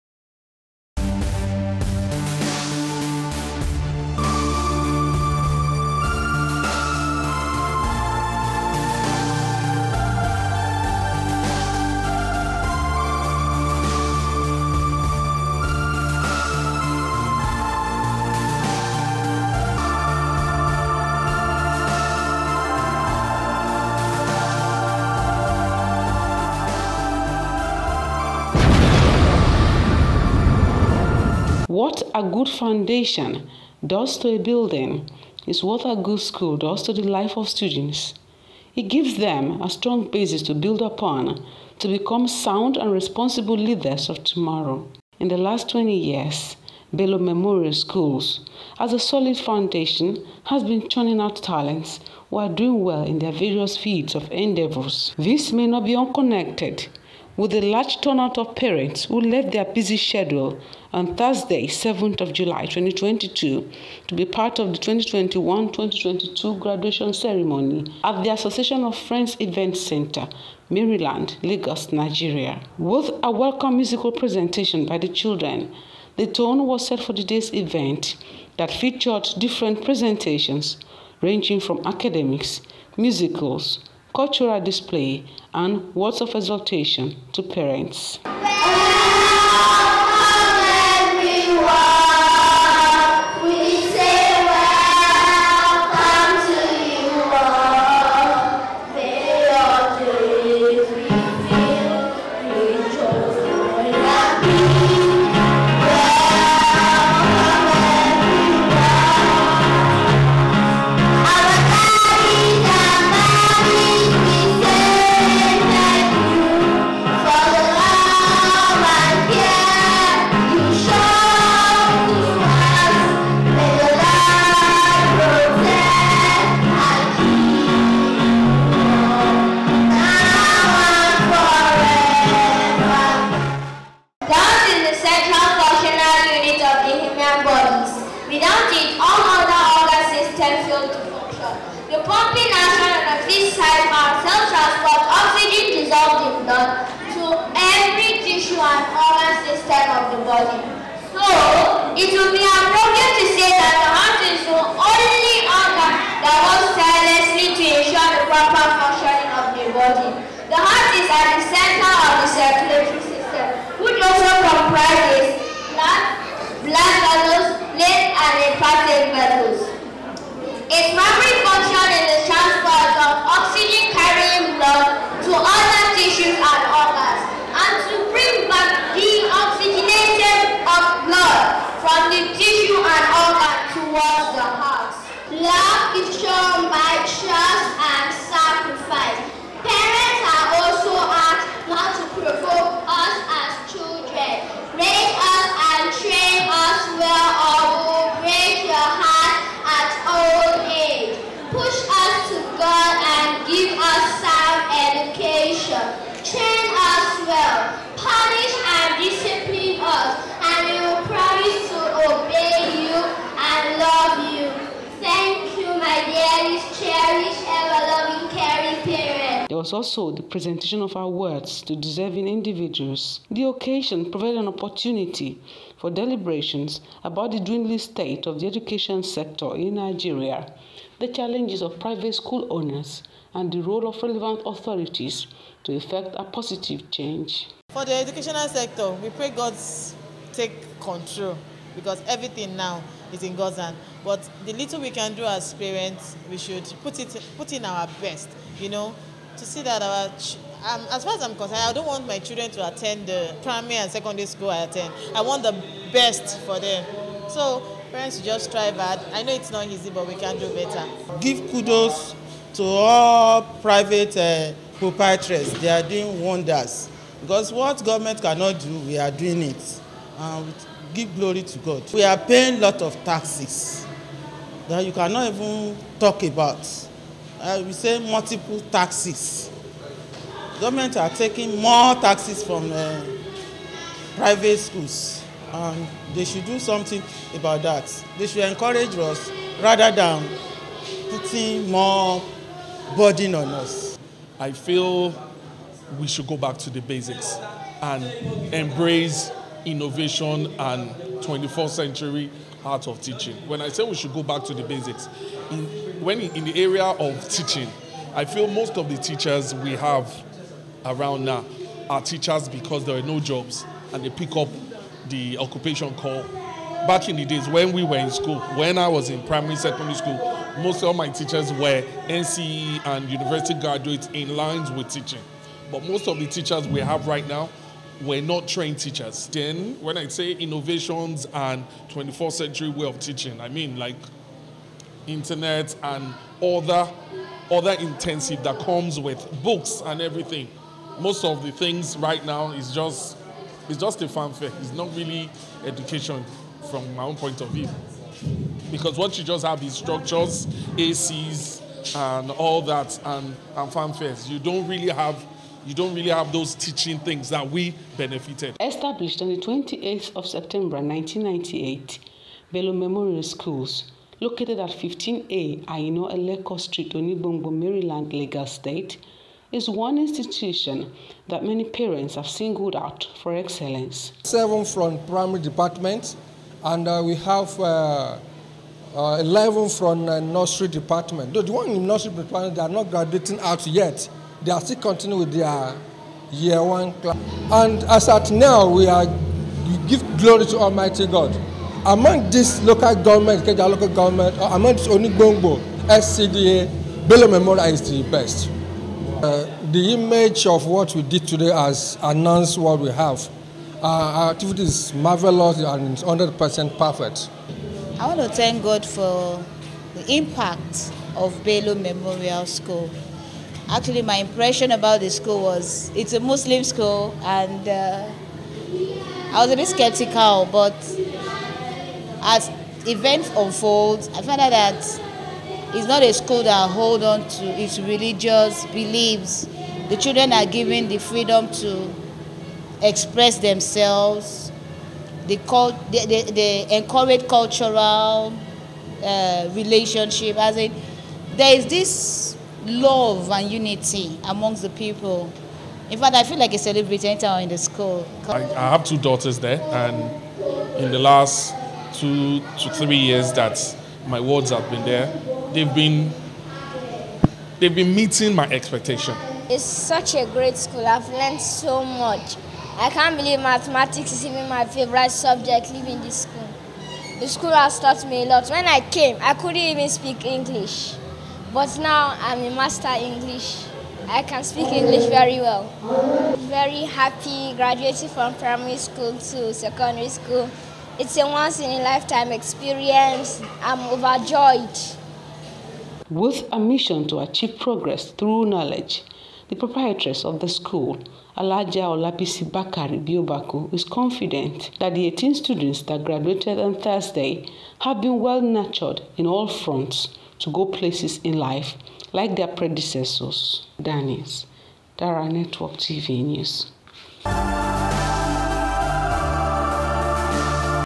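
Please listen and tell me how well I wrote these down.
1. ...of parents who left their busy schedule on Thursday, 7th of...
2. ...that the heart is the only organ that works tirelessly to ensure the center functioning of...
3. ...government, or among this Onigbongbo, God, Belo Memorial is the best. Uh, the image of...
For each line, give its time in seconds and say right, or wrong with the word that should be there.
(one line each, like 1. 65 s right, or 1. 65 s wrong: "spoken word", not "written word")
1. 58 s right
2. 153 s wrong: "proper", not "center"
3. 393 s wrong: "SCDA", not "God".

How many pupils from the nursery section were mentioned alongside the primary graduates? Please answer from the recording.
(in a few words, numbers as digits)
11.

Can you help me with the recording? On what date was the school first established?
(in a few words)
28 September 1998.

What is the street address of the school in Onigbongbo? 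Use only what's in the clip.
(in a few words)
15A Aino Eleko Street.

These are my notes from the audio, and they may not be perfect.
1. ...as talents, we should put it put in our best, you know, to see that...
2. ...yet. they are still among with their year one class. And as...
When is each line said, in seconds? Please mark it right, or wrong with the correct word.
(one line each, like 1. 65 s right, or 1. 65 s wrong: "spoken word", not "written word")
1. 245 s wrong: "parents", not "talents"
2. 383 s wrong: "continuing", not "among".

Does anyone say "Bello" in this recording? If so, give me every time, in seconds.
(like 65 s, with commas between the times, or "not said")
46 s, 362 s.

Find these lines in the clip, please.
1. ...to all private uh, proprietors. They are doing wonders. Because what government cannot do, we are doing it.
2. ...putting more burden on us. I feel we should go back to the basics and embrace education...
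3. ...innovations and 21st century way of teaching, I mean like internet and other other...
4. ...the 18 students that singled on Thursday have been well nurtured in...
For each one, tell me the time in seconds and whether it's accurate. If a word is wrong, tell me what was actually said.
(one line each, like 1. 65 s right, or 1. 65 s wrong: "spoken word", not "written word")
1. 262 s right
2. 291 s wrong: "innovation", not "education"
3. 330 s right
4. 494 s wrong: "graduated", not "singled".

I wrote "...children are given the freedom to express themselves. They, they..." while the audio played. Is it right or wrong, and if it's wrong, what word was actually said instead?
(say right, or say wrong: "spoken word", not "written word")
right.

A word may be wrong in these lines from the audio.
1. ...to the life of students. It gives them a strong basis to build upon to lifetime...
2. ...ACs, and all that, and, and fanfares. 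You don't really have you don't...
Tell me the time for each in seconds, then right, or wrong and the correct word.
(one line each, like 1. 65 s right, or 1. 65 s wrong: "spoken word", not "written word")
1. 36 s wrong: "become", not "lifetime"
2. 350 s right.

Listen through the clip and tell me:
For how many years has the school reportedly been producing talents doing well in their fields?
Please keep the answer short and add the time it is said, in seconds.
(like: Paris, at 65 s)
20 years, at 45 s.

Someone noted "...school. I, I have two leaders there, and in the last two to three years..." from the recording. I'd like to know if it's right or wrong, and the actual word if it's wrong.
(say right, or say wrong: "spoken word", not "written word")
wrong: "daughters", not "leaders".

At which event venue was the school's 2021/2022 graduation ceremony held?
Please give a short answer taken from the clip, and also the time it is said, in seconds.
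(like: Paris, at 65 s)
Association of Friends Event Center, at 68 s.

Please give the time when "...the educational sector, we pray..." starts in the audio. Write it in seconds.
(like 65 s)
237 s.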